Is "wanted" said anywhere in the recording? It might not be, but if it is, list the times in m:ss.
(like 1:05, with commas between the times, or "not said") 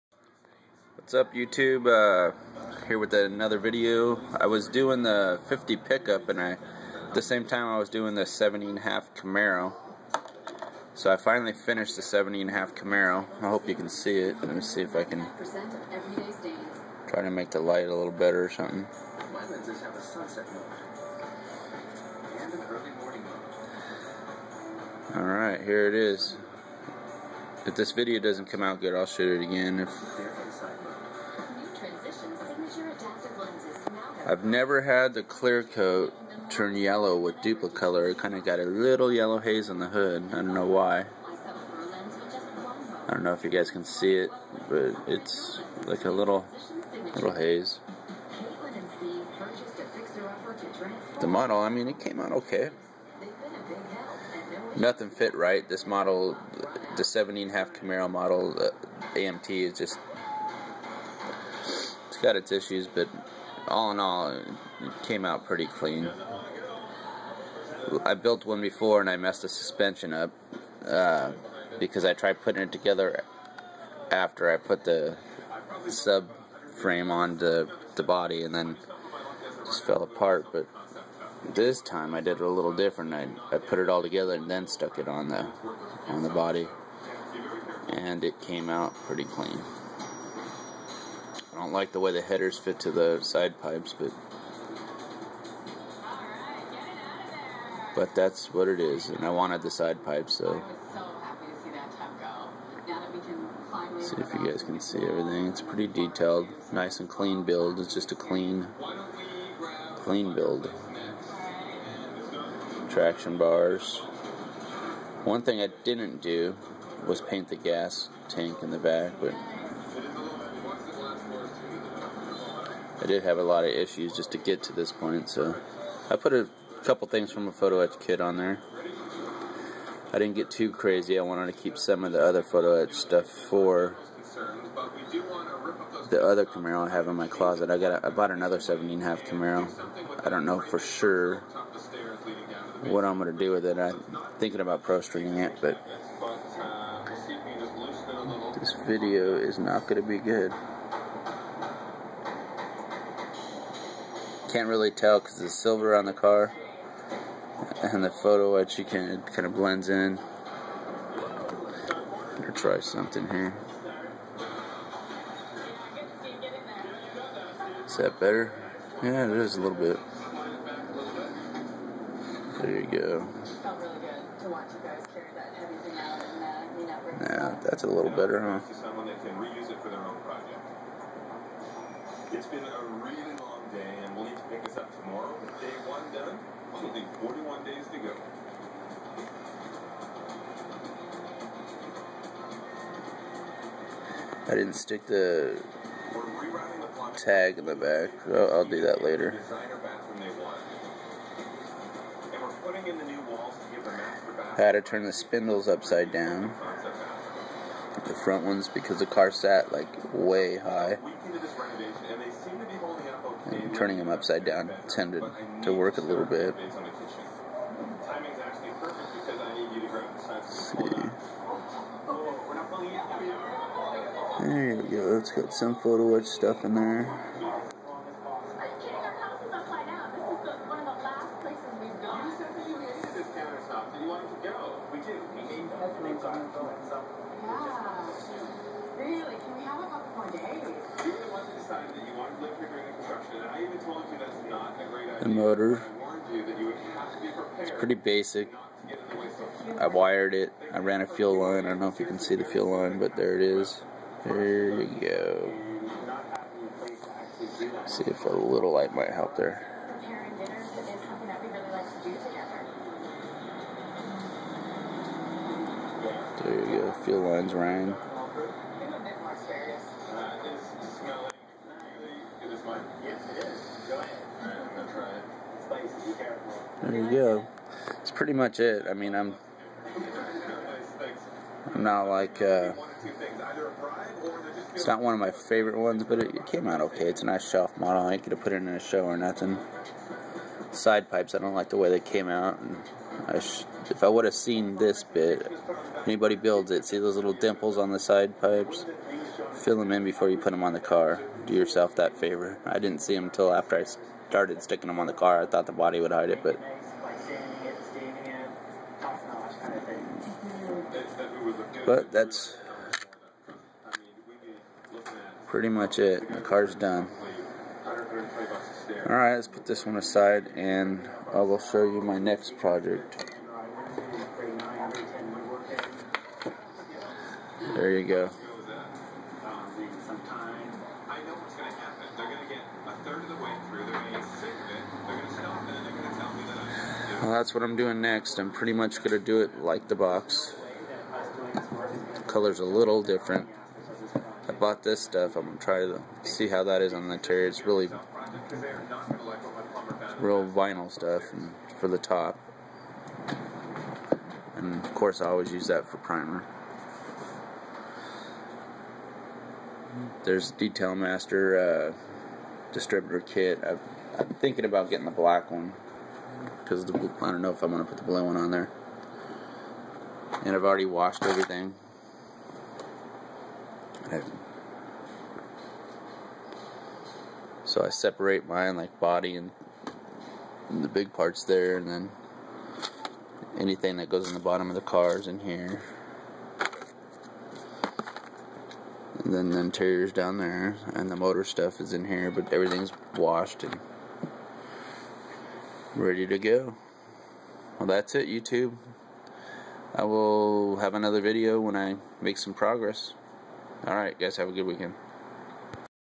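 1:39, 2:11.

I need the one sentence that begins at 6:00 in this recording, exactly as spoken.
There's Detail Master uh, distributor kit.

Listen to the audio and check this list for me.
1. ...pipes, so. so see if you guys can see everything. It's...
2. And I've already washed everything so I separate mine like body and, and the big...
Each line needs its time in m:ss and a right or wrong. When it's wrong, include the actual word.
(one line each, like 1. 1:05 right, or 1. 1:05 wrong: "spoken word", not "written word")
1. 1:40 right
2. 6:10 right.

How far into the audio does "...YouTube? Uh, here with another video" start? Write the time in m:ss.
0:01.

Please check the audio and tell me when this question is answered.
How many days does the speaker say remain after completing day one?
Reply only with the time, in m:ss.
3:07.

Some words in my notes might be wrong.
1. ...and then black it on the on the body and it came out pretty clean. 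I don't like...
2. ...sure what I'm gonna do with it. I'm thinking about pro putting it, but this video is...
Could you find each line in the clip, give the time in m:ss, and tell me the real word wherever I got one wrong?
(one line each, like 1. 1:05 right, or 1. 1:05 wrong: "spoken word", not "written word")
1. 1:24 wrong: "stuck", not "black"
2. 2:20 wrong: "streeting", not "putting".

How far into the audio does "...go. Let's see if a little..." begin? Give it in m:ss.
4:14.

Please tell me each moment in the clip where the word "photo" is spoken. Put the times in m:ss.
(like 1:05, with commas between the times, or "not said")
2:07, 2:12, 2:38, 3:45.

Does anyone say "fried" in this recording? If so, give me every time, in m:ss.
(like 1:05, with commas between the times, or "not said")
not said.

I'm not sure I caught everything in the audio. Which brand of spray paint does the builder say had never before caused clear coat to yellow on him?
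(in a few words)
Dupli-Color.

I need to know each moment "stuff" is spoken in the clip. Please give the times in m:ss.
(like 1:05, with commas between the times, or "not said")
2:12, 3:46, 5:45, 5:50, 6:31.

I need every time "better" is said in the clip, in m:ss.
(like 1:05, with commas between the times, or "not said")
0:18, 2:42, 2:48, 2:58.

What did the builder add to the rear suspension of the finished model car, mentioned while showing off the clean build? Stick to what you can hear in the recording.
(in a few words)
Traction bars.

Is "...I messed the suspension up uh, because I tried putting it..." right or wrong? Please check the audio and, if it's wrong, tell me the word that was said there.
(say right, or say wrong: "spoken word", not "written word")
right.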